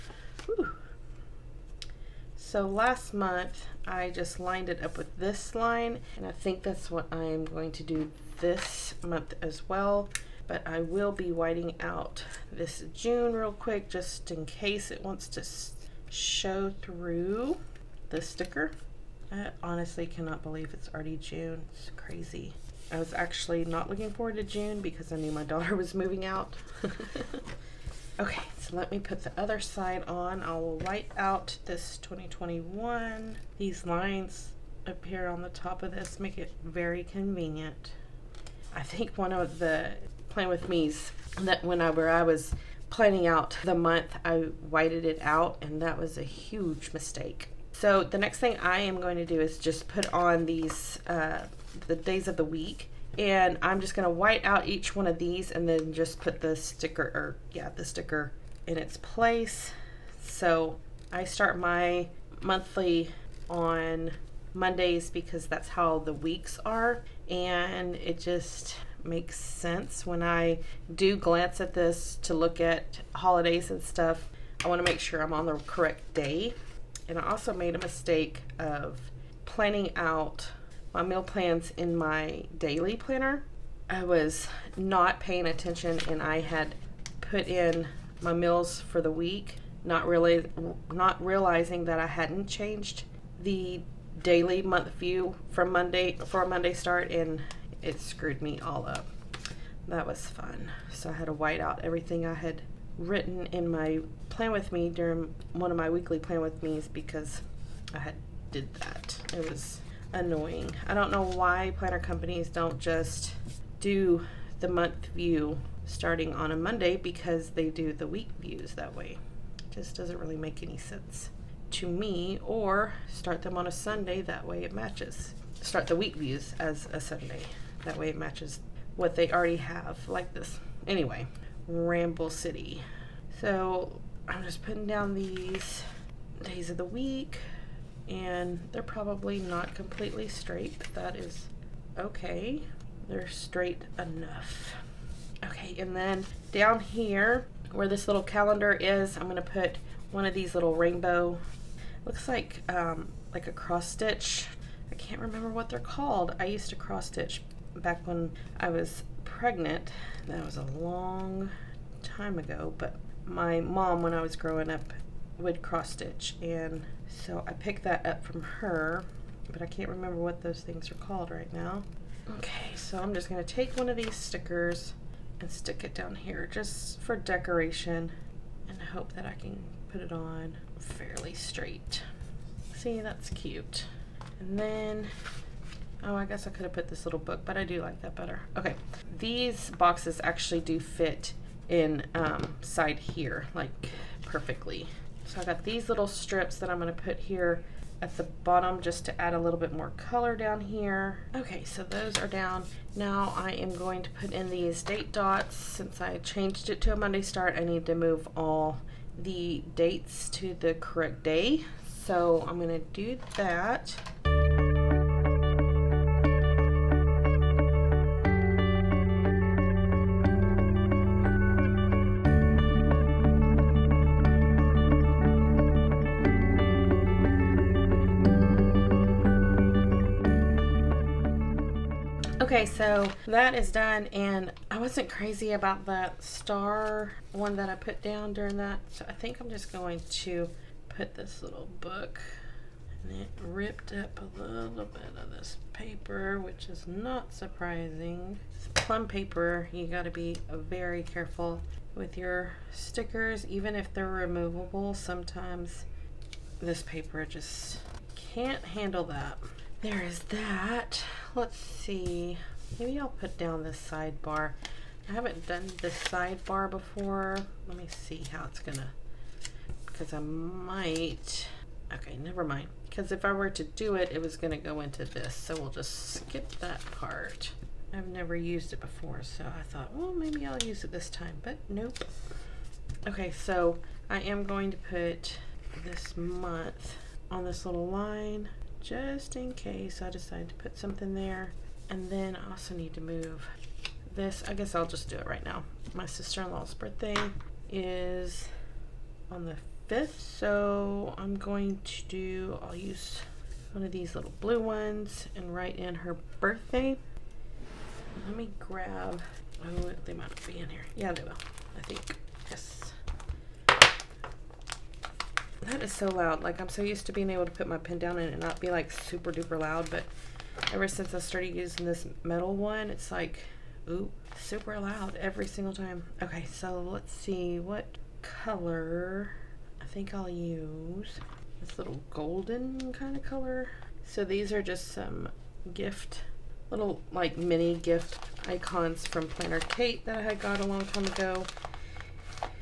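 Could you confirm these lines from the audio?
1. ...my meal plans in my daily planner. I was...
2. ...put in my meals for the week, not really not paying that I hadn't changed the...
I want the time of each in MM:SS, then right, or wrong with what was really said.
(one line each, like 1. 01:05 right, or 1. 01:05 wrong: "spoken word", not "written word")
1. 01:20 right
2. 01:27 wrong: "realizing", not "paying".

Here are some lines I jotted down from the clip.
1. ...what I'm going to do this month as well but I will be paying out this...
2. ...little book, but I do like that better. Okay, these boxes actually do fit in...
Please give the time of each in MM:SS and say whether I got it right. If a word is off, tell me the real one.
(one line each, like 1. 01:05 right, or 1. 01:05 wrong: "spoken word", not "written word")
1. 00:06 wrong: "whiting", not "paying"
2. 03:07 right.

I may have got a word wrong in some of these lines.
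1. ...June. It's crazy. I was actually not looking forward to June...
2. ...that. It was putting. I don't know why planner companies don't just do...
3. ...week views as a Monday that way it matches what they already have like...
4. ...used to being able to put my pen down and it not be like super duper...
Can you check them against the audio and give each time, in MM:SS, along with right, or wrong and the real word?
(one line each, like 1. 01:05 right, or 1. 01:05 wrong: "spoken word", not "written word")
1. 00:21 right
2. 01:48 wrong: "annoying", not "putting"
3. 02:05 wrong: "Sunday", not "Monday"
4. 05:16 right.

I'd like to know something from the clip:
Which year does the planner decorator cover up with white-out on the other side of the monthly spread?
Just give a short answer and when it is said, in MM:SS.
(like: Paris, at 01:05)
2021, at 00:31.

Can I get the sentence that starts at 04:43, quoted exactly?
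Okay, so I am going to put this month on this little line just in case I decide to put something there.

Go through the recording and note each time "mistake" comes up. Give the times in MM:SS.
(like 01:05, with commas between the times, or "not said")
00:46, 01:17.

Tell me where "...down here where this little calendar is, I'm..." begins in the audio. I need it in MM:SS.
02:26.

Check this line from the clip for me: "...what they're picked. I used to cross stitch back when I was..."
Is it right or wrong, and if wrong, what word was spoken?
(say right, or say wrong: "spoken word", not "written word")
wrong: "called", not "picked".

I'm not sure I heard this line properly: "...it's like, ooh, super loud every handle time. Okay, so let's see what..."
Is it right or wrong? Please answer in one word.
wrong.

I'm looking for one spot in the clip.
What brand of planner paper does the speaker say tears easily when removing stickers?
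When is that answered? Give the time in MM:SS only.
04:08.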